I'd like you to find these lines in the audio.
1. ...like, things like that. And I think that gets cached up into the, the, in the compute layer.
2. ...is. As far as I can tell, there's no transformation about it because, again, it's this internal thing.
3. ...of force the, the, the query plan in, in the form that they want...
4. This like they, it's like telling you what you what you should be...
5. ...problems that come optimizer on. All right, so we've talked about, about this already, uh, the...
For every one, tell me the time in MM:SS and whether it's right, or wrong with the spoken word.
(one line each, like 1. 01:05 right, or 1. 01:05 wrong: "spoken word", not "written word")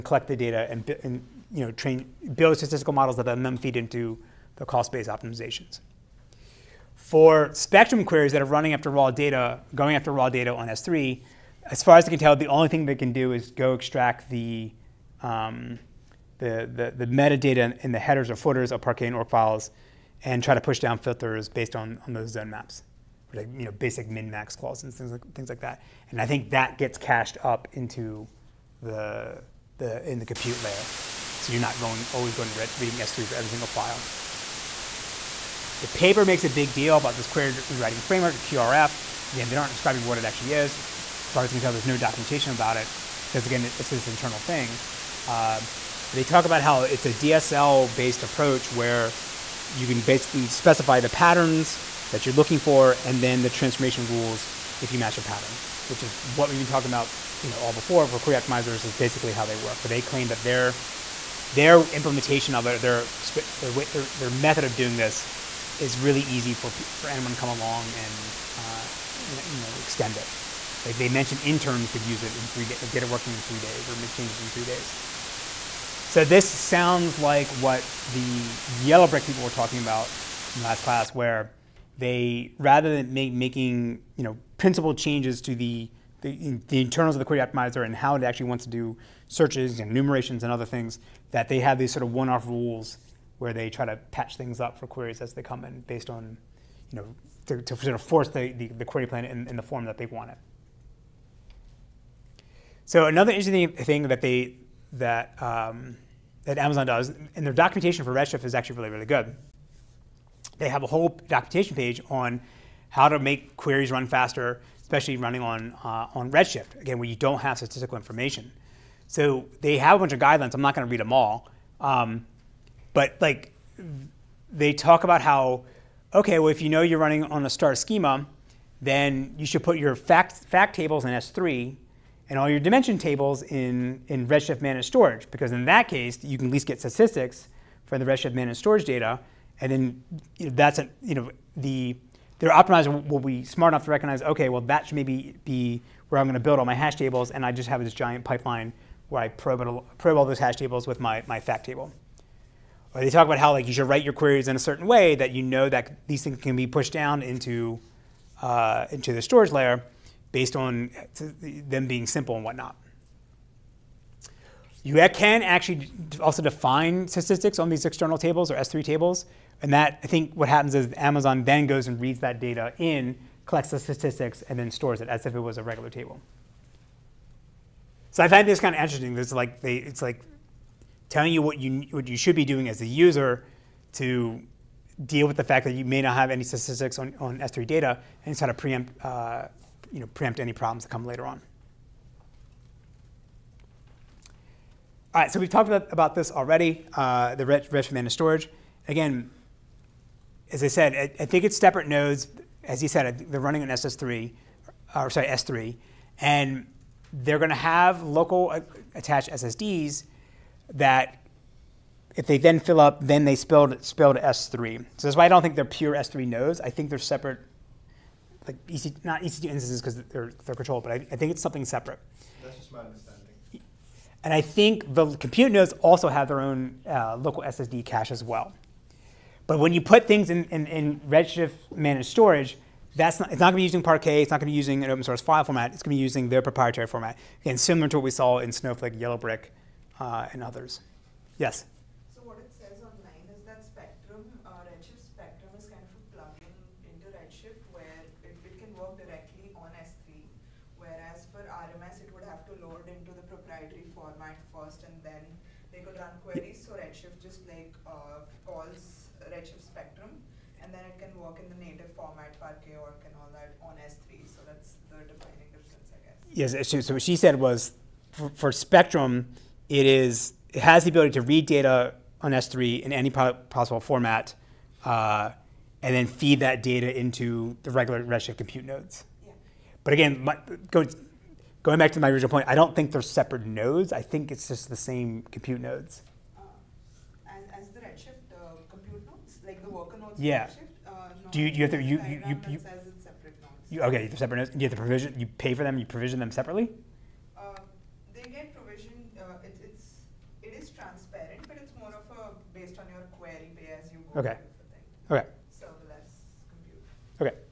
1. 00:25 right
2. 00:40 wrong: "documentation", not "transformation"
3. 01:37 right
4. 02:59 right
5. 03:10 wrong: "later", not "optimizer".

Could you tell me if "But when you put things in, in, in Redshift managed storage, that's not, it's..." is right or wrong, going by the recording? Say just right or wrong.
right.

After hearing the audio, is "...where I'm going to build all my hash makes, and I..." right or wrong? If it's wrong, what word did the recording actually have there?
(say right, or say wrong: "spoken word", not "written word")
wrong: "tables", not "makes".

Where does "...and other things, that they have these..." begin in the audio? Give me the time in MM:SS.
01:30.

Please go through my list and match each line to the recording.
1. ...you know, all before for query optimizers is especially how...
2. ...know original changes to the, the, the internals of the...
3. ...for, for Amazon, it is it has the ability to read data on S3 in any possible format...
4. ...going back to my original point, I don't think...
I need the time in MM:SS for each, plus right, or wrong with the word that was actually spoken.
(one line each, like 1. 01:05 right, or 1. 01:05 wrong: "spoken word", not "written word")
1. 00:57 wrong: "basically", not "especially"
2. 01:24 wrong: "principal", not "original"
3. 04:28 wrong: "Spectrum", not "Amazon"
4. 04:41 right.